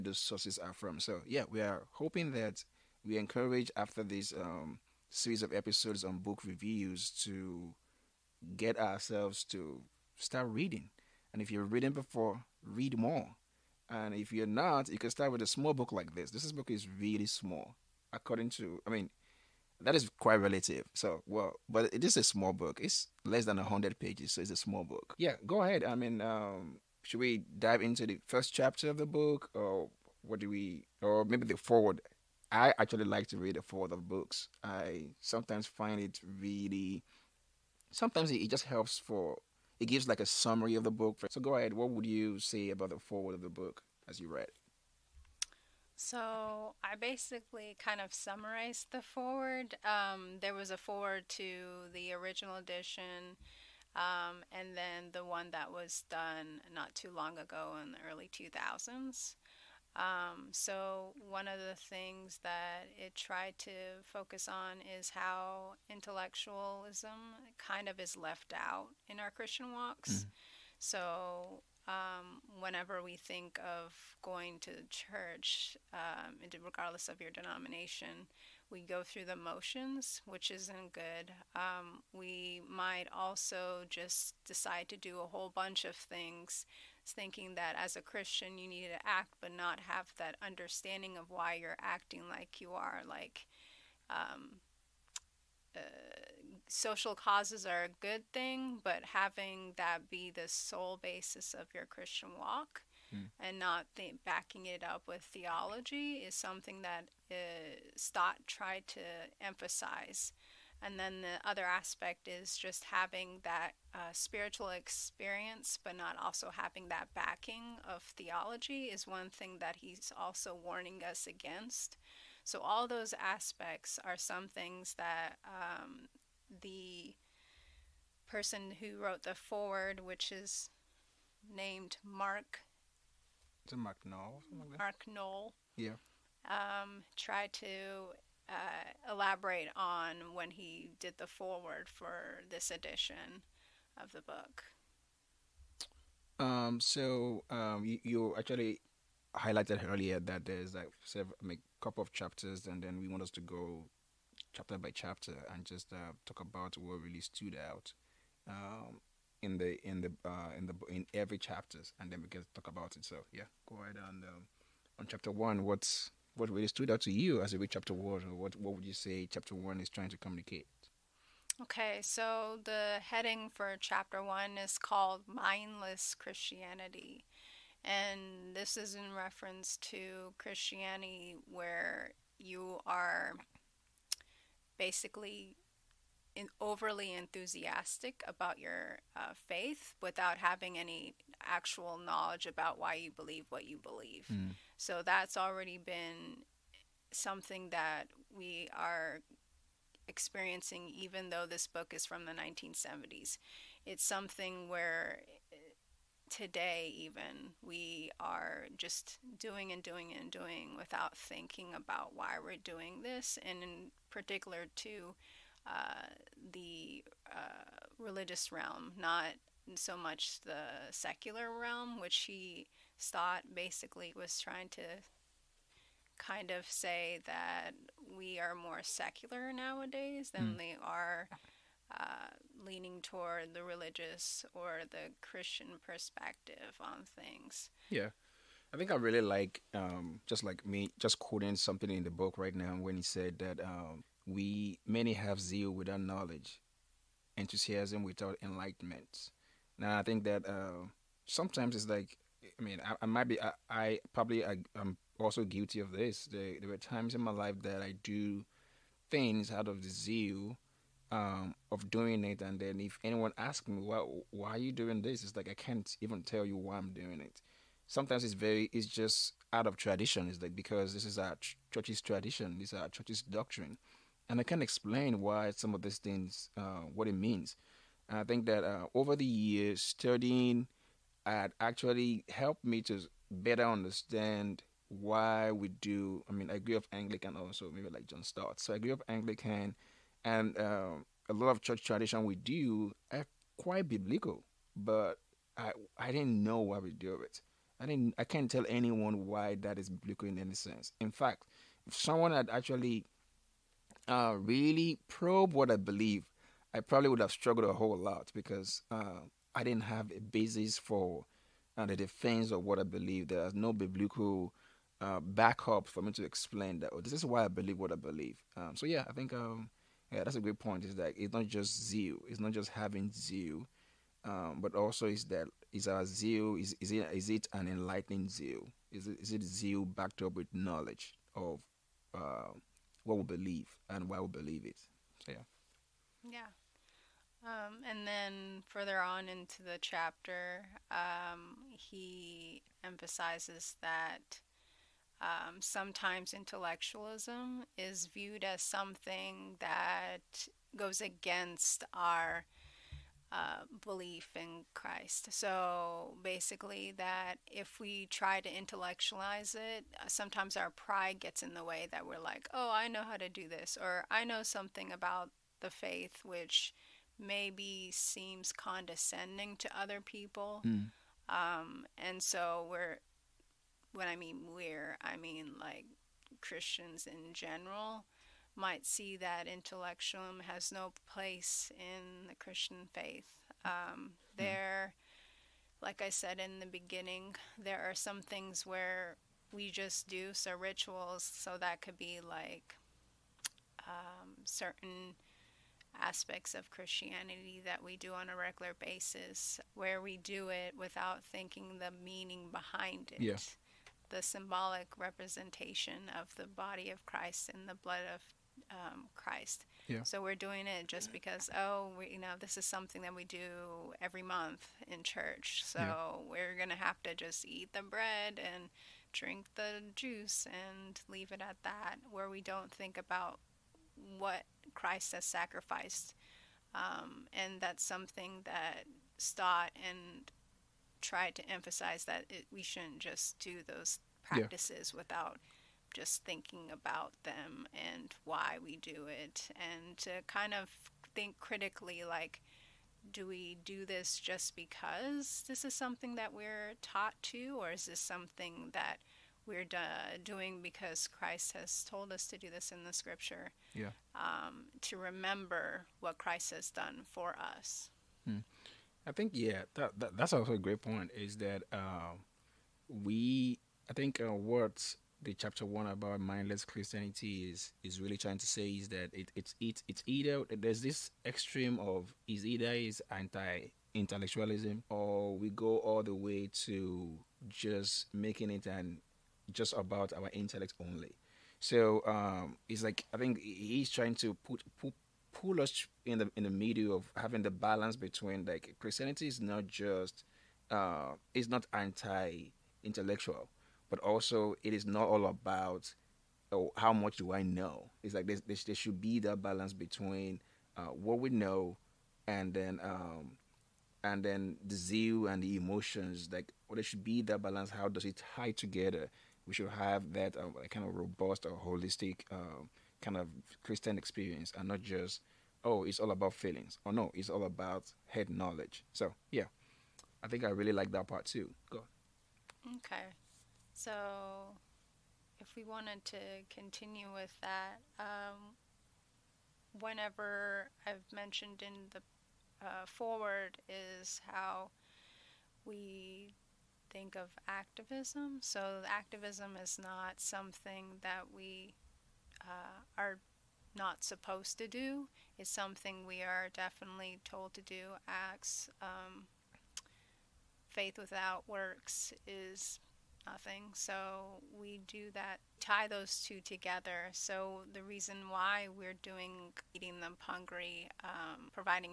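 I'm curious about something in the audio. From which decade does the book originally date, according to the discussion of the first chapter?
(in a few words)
1970s.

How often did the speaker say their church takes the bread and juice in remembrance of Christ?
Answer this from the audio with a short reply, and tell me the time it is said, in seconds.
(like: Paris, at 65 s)
every month, at 414 s.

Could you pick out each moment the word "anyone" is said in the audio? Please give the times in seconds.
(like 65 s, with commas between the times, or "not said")
263 s, 298 s.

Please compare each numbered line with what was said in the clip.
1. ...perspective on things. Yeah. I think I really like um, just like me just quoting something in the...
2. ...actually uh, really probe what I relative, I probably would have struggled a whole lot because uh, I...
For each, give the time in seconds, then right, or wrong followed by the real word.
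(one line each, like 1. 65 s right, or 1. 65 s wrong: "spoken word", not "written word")
1. 235 s right
2. 302 s wrong: "believe", not "relative".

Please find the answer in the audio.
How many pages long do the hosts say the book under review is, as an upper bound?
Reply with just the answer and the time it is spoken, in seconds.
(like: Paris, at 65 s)
100, at 23 s.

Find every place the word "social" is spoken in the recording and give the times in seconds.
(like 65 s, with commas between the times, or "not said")
96 s.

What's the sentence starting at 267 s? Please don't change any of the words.
Sometimes it's very, it's just out of tradition.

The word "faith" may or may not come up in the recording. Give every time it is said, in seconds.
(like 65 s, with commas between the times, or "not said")
189 s, 365 s, 382 s, 550 s.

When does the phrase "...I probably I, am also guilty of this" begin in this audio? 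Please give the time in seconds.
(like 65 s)
253 s.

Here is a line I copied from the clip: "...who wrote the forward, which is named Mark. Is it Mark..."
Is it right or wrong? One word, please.
right.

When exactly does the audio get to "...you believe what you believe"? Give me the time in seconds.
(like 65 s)
192 s.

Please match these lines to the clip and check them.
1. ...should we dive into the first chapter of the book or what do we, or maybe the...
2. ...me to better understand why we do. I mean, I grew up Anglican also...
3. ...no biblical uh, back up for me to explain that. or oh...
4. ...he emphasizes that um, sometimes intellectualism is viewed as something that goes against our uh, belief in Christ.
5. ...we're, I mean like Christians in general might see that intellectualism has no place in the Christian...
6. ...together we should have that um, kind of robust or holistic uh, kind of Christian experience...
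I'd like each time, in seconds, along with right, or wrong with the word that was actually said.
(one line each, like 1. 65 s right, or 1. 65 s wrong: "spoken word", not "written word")
1. 27 s right
2. 282 s right
3. 313 s right
4. 341 s right
5. 374 s right
6. 508 s right.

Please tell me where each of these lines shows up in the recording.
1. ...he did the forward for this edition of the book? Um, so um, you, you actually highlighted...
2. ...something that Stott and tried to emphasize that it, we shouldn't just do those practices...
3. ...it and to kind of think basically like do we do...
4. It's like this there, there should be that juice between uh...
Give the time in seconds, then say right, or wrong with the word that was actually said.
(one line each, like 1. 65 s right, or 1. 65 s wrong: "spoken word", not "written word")
1. 140 s right
2. 427 s right
3. 439 s wrong: "critically", not "basically"
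4. 498 s wrong: "balance", not "juice".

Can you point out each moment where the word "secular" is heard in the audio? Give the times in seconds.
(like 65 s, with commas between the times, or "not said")
220 s, 228 s.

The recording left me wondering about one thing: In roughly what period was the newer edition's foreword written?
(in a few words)
early 2000s.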